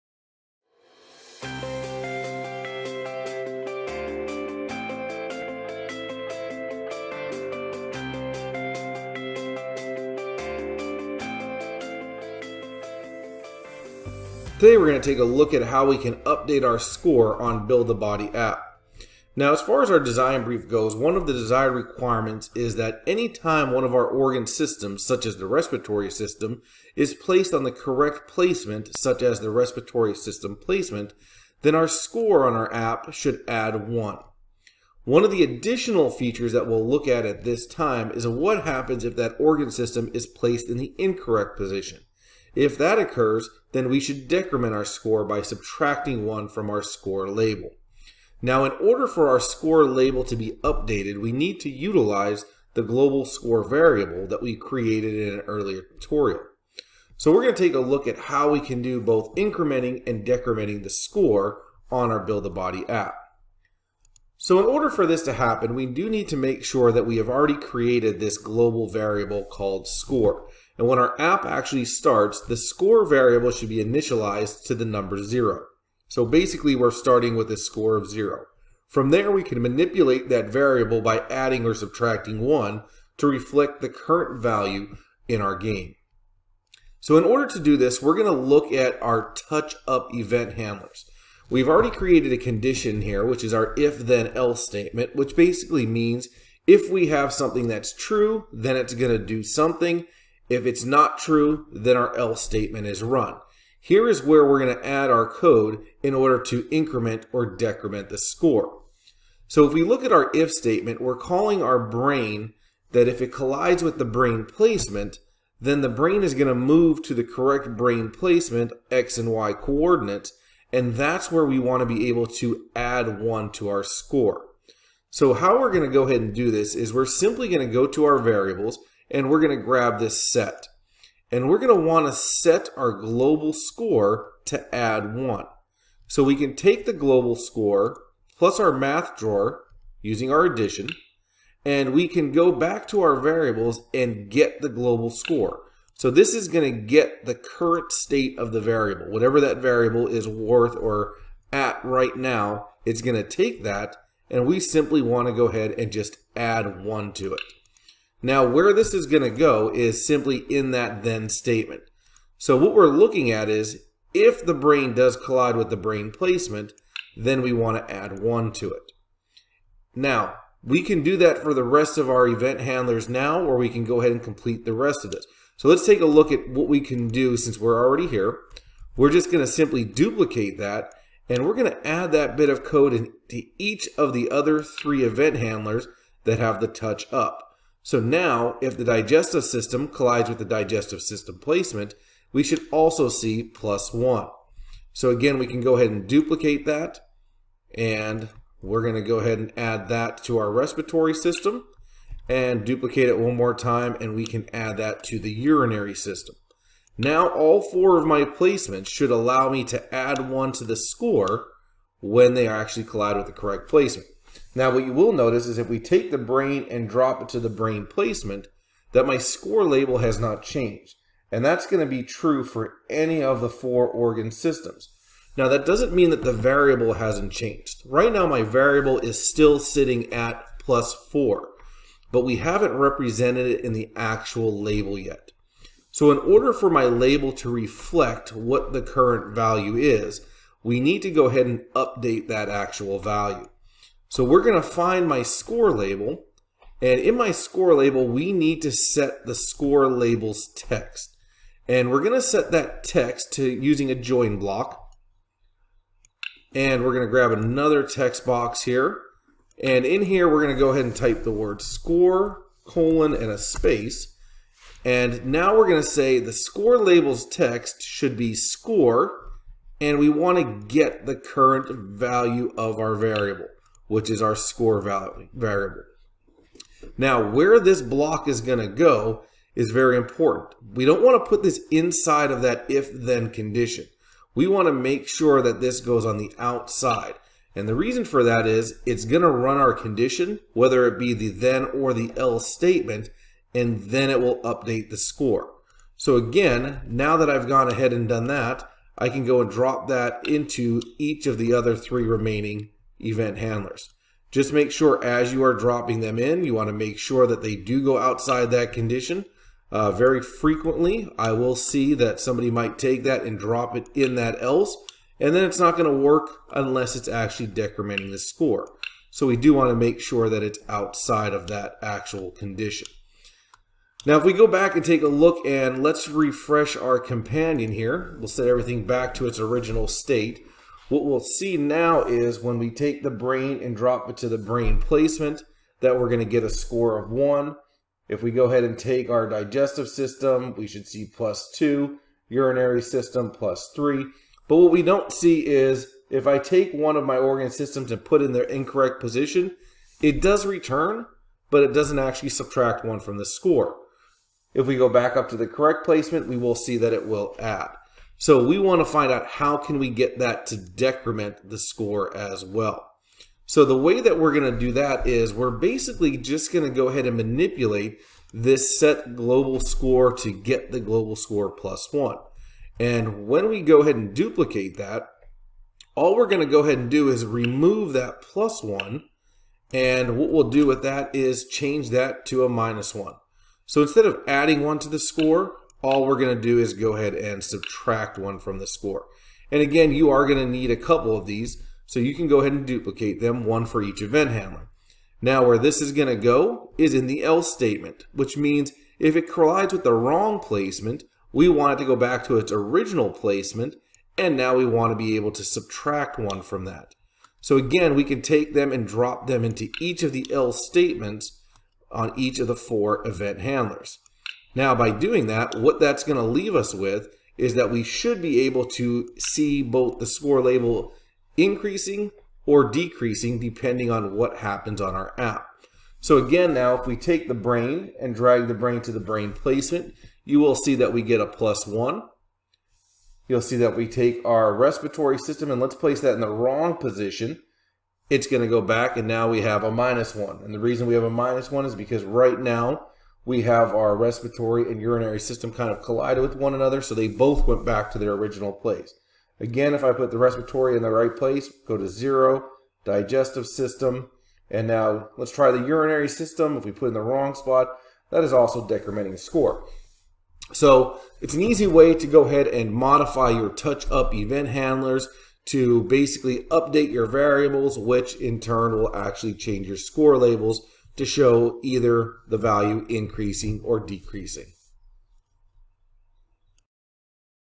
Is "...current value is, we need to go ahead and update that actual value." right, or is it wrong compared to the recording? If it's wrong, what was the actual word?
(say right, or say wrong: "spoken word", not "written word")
right.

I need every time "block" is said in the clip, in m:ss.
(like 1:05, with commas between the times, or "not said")
4:14, 4:37.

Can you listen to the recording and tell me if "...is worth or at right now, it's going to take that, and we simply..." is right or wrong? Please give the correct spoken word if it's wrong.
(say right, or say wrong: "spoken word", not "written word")
right.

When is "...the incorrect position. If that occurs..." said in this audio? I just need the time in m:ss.
0:40.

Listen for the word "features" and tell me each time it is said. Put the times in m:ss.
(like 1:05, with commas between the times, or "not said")
0:36.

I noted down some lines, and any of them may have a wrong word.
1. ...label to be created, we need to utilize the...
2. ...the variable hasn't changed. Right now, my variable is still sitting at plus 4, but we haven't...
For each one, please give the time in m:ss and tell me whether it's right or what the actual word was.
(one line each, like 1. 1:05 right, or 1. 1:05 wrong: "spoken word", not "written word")
1. 0:49 wrong: "updated", not "created"
2. 3:46 right.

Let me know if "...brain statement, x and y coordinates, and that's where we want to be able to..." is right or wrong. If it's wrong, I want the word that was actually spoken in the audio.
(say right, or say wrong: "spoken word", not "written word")
wrong: "placement", not "statement".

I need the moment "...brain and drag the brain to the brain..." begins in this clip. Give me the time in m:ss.
7:07.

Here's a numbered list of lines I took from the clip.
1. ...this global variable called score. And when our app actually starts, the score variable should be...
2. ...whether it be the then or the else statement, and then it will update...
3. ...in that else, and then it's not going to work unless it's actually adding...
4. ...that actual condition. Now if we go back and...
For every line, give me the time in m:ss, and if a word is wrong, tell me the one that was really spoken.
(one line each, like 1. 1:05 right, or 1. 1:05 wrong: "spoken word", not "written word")
1. 1:08 right
2. 4:50 right
3. 5:13 wrong: "decrementing", not "adding"
4. 5:21 right.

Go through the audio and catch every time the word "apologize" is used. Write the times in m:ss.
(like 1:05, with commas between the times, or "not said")
not said.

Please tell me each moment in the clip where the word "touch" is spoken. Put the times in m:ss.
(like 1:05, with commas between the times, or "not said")
1:29, 3:06, 7:43.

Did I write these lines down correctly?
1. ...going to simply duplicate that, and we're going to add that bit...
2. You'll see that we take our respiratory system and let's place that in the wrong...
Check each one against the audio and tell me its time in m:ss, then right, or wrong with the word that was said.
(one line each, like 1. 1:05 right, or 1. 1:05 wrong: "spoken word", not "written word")
1. 2:59 right
2. 7:13 right.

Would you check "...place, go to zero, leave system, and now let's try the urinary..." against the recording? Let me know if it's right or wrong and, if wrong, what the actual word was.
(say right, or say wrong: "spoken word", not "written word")
wrong: "digestive", not "leave".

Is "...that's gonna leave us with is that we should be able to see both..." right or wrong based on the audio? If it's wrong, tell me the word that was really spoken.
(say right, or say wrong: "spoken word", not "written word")
right.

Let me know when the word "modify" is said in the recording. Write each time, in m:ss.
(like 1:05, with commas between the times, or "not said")
7:42.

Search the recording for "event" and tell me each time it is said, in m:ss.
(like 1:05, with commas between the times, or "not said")
1:30, 2:52, 3:05, 5:03, 6:34, 6:53, 7:44.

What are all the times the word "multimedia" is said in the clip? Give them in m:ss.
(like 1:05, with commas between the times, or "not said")
not said.